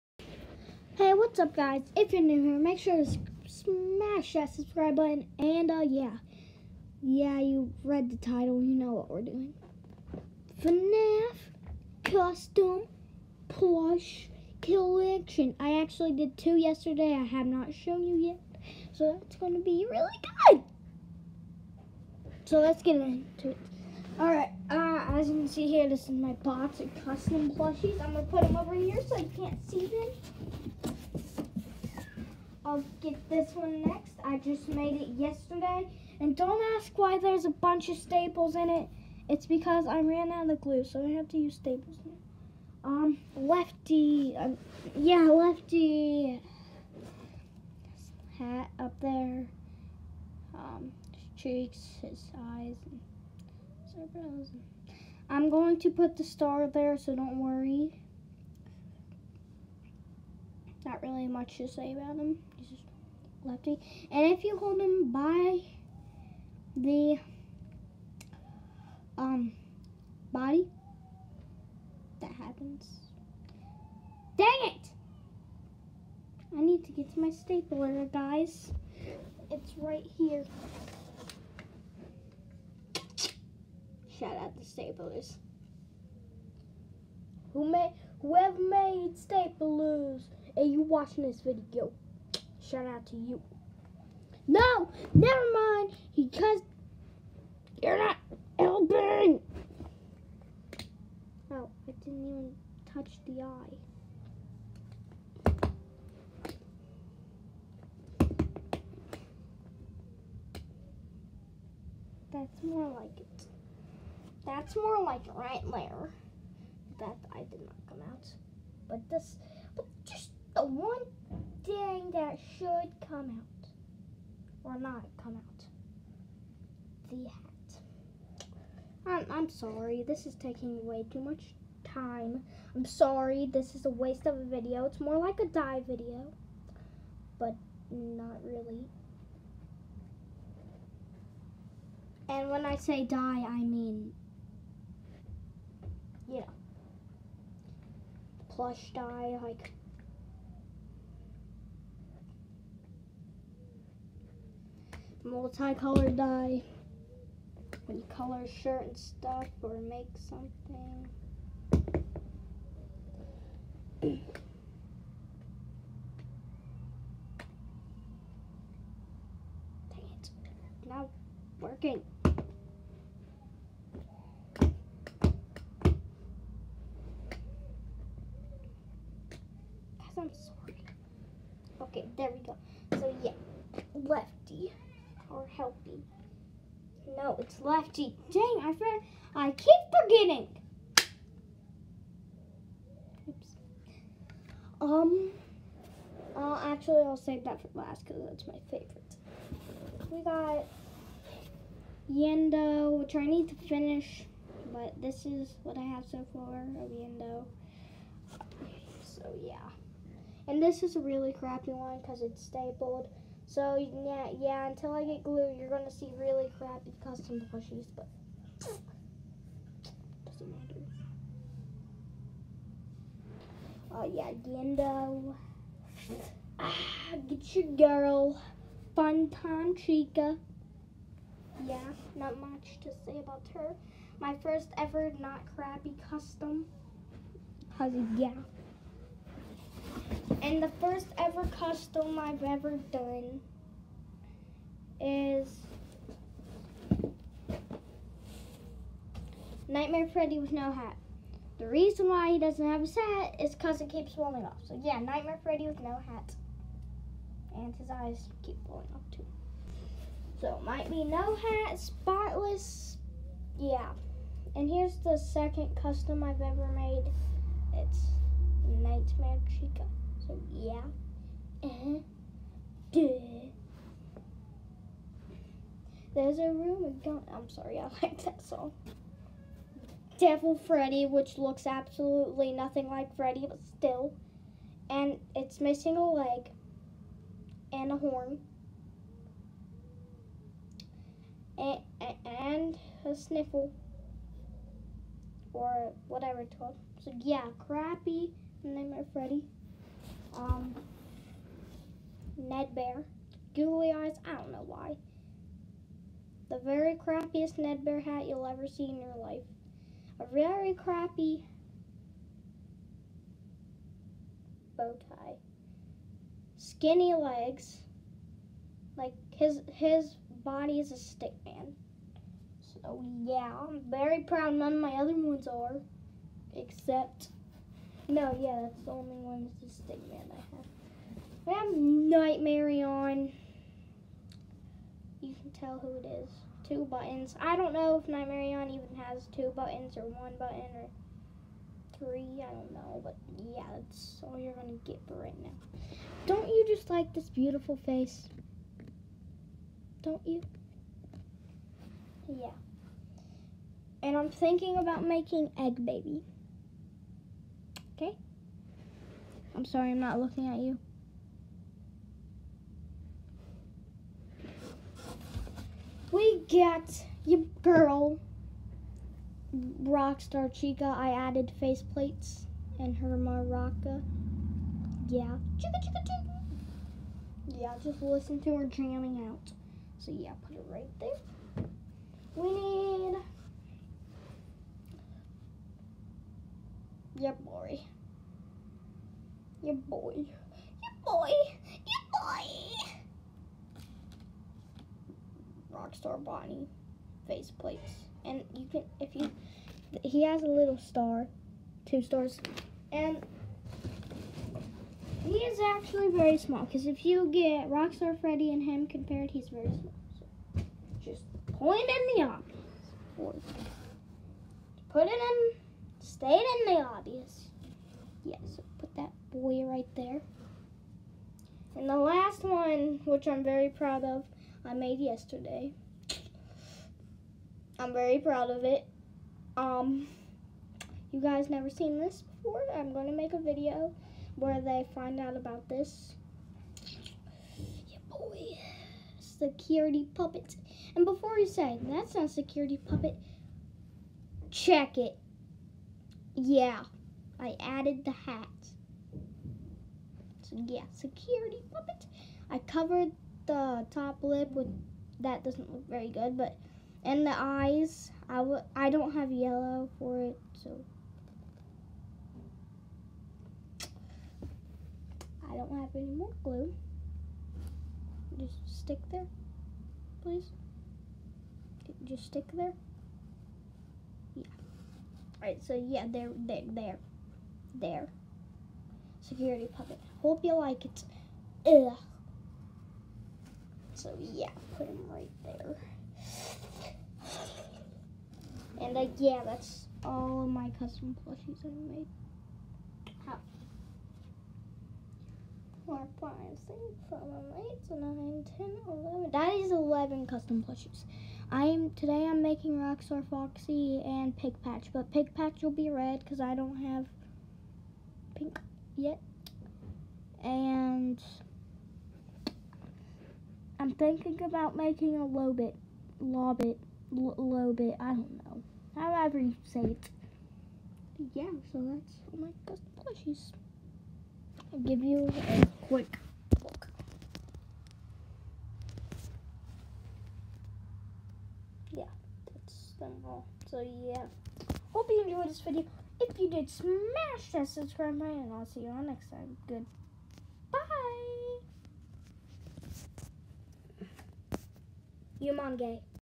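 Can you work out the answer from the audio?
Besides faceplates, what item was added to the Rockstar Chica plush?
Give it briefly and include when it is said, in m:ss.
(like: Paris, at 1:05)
Her maraca, at 6:12.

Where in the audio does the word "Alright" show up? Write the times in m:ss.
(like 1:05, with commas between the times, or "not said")
0:24, 7:55.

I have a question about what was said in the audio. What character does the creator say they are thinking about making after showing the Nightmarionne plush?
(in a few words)
Egg Baby.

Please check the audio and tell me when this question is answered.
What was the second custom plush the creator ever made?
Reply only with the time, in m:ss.
4:27.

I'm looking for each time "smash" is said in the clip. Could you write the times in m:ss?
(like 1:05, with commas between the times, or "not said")
0:03, 8:56.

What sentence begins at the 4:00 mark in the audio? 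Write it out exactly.
And the first ever custom I've ever done is Nightmare Freddy with no hat.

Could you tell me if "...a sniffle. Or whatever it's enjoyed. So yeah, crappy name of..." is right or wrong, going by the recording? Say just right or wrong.
wrong.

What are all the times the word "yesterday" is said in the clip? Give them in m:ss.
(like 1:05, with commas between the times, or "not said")
0:16, 0:35, 7:04.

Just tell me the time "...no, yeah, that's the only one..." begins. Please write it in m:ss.
5:28.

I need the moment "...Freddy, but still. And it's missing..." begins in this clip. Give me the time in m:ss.
4:43.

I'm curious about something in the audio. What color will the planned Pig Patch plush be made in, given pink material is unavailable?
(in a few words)
Red.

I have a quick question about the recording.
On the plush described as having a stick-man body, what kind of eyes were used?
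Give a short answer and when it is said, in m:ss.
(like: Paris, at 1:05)
Googly eyes, at 5:03.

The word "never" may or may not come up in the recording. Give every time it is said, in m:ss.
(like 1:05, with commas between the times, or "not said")
1:35, 7:11.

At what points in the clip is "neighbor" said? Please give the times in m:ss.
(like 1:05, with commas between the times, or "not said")
not said.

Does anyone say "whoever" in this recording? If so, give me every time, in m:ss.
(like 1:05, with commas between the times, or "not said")
1:28.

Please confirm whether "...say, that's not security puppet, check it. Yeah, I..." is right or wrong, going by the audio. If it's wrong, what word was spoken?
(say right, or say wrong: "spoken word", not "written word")
right.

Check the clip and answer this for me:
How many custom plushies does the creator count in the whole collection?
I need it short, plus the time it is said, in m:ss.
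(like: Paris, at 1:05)
11, at 8:19.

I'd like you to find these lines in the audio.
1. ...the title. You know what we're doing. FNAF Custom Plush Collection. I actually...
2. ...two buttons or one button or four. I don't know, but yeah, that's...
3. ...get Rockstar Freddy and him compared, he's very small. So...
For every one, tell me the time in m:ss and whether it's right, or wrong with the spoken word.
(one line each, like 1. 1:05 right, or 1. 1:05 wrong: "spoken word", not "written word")
1. 0:08 right
2. 5:39 wrong: "three", not "four"
3. 6:47 right.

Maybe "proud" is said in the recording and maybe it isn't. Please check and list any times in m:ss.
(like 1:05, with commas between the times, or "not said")
5:24, 7:03, 7:08.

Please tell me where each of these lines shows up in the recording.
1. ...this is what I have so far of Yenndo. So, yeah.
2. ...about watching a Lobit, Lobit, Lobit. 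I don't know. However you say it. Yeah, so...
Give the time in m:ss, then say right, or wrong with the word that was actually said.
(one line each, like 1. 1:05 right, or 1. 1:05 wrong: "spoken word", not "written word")
1. 3:25 right
2. 8:34 wrong: "making", not "watching".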